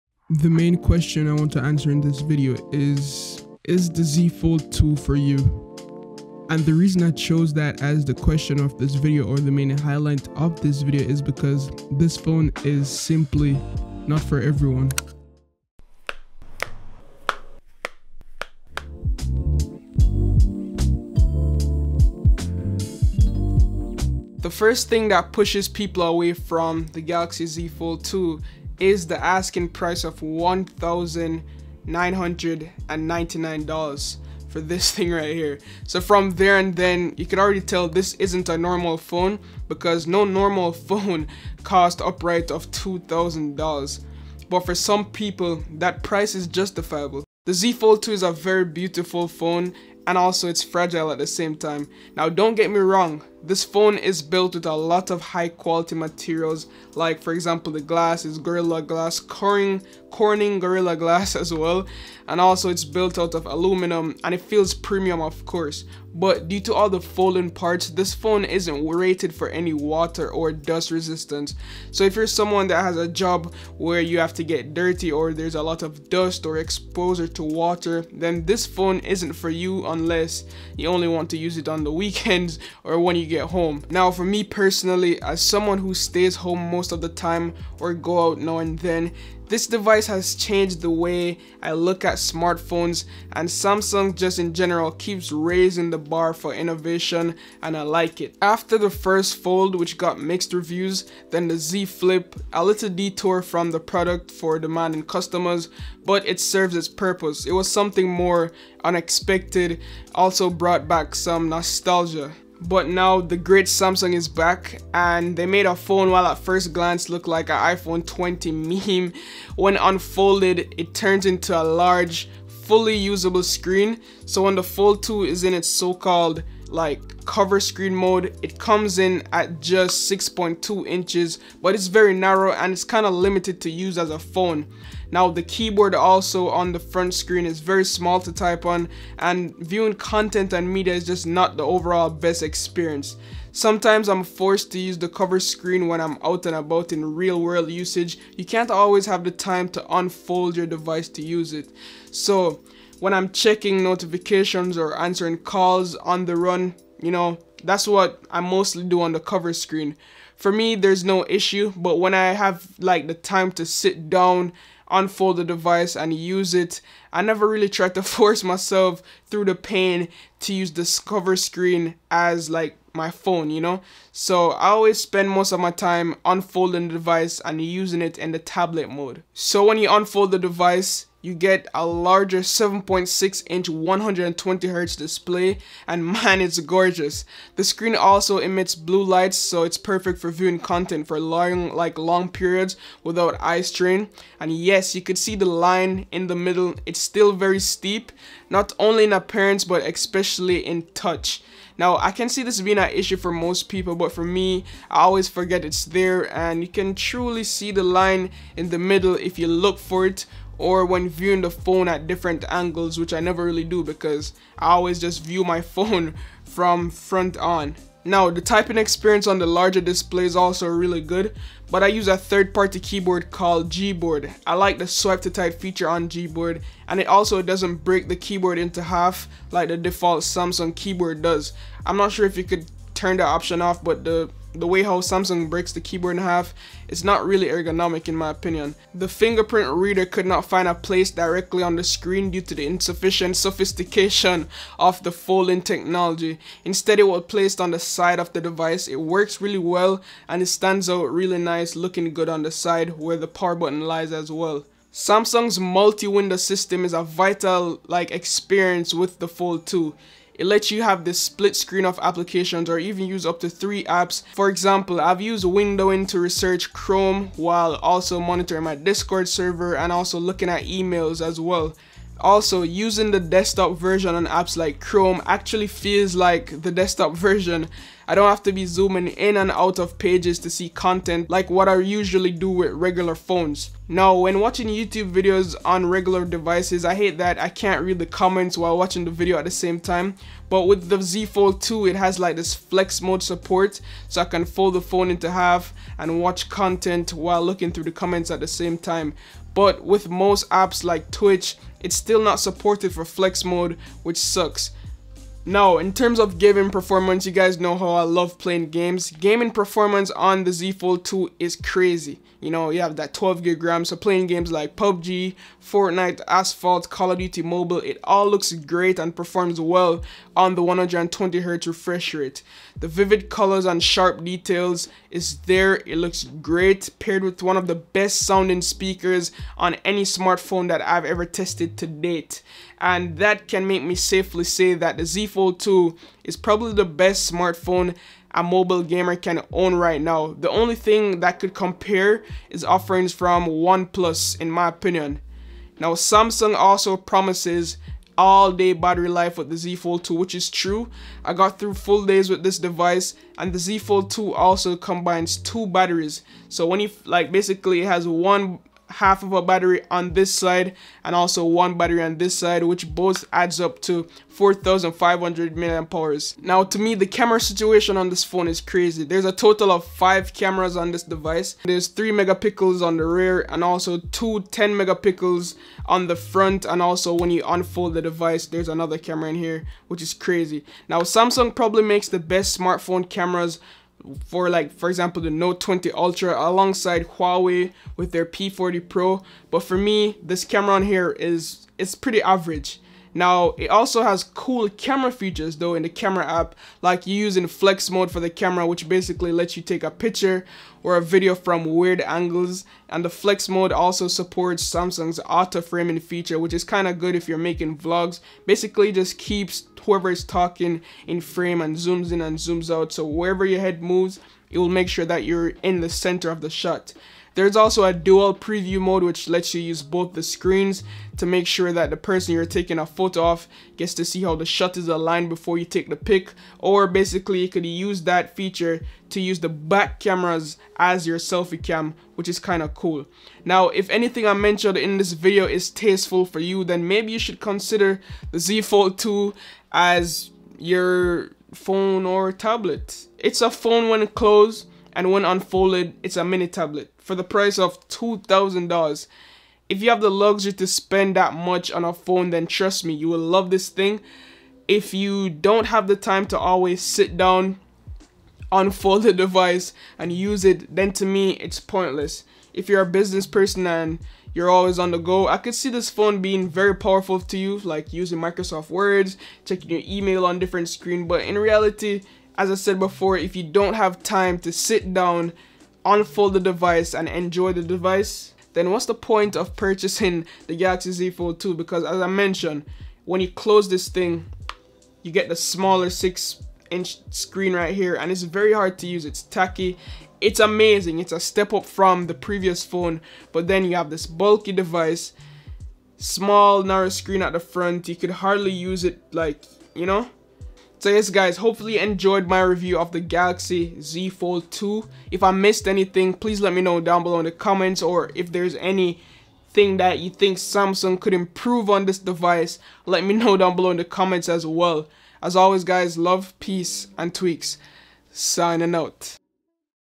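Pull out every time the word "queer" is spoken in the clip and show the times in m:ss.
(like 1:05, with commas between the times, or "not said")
not said.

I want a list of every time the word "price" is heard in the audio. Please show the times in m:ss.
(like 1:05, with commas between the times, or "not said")
0:29, 0:46, 7:27.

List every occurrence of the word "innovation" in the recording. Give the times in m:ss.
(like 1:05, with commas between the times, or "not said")
1:36.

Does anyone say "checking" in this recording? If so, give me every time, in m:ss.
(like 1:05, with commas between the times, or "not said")
2:33, 7:49.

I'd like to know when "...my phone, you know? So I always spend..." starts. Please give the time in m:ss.
2:52.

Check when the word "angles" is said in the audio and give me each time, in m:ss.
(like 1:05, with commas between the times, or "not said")
3:32, 6:42.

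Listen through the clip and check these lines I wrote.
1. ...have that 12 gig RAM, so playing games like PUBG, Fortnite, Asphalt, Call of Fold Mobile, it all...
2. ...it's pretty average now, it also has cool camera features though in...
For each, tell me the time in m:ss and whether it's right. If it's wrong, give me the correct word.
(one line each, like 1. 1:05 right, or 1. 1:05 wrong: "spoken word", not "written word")
1. 5:12 wrong: "Duty", not "Fold"
2. 6:31 right.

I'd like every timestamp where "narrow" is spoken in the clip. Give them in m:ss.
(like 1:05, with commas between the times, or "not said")
2:12, 8:16.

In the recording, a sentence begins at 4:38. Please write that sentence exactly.
I don't have to be zooming in and out of pages to see content like what I usually do with regular phones.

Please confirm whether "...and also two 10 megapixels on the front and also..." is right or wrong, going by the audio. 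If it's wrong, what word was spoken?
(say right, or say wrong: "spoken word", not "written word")
right.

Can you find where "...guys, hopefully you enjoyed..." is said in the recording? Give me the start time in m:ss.
8:21.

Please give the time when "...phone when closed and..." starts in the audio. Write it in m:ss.
7:23.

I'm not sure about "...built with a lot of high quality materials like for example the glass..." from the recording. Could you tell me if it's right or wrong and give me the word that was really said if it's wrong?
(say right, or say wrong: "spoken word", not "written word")
right.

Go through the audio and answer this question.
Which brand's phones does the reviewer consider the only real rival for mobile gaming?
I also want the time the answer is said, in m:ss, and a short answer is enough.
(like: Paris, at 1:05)
OnePlus, at 5:43.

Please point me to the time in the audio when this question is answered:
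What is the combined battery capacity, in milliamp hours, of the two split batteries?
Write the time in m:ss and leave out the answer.
6:04.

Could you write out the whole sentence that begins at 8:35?
As always guys, love, peace, and tweaks.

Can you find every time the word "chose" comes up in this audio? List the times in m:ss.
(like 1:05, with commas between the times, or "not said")
0:07.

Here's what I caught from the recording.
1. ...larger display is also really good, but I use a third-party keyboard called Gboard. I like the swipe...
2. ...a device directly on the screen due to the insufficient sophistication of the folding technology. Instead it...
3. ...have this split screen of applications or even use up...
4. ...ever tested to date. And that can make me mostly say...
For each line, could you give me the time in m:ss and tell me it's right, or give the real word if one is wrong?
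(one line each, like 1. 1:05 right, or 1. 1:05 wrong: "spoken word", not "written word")
1. 3:39 right
2. 4:00 wrong: "place", not "device"
3. 4:20 right
4. 5:31 wrong: "safely", not "mostly".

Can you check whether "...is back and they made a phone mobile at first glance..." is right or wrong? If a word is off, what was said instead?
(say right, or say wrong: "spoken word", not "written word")
wrong: "while", not "mobile".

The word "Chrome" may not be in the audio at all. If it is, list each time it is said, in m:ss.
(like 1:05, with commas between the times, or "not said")
4:26, 4:34.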